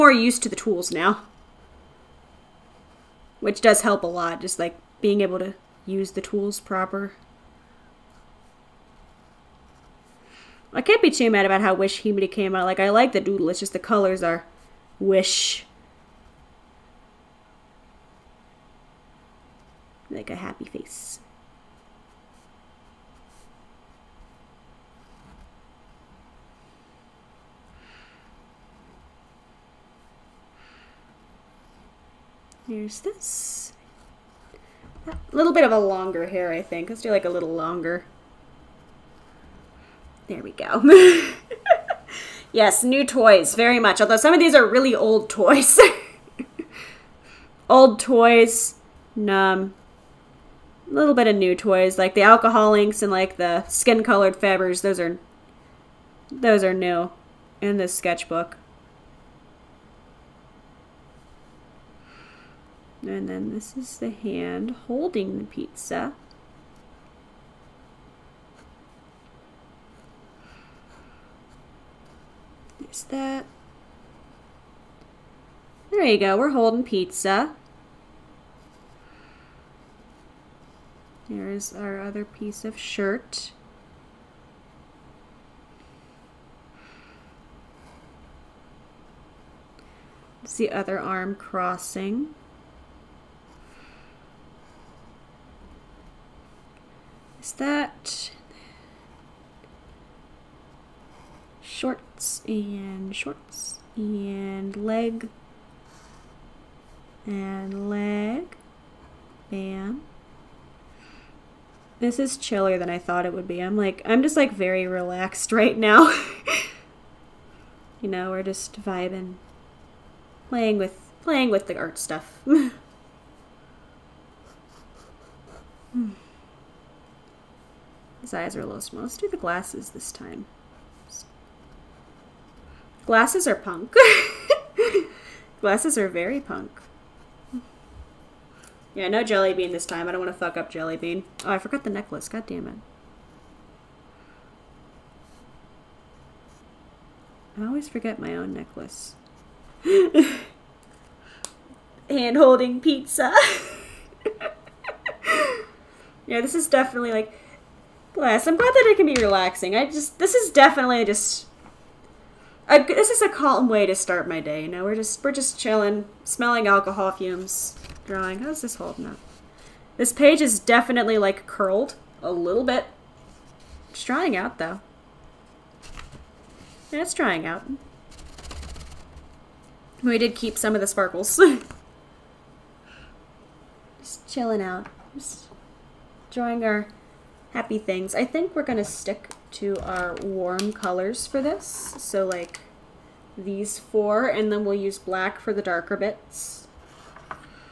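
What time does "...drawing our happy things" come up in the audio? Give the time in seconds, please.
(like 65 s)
186 s.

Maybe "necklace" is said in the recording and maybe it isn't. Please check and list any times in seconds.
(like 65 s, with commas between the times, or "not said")
141 s, 148 s.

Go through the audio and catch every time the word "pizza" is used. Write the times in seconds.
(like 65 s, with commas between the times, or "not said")
65 s, 76 s, 152 s.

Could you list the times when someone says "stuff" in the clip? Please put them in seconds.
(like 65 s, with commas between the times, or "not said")
121 s.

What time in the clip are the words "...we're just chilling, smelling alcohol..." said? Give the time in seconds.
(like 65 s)
165 s.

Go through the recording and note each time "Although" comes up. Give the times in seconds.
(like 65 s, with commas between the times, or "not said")
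44 s.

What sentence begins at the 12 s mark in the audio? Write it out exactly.
Like, I like the doodle, it's just the colors are Wish.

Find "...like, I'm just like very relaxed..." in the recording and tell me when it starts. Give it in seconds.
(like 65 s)
113 s.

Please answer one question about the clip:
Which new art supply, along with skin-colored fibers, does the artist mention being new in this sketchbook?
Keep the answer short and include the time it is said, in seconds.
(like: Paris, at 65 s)
Alcohol inks, at 52 s.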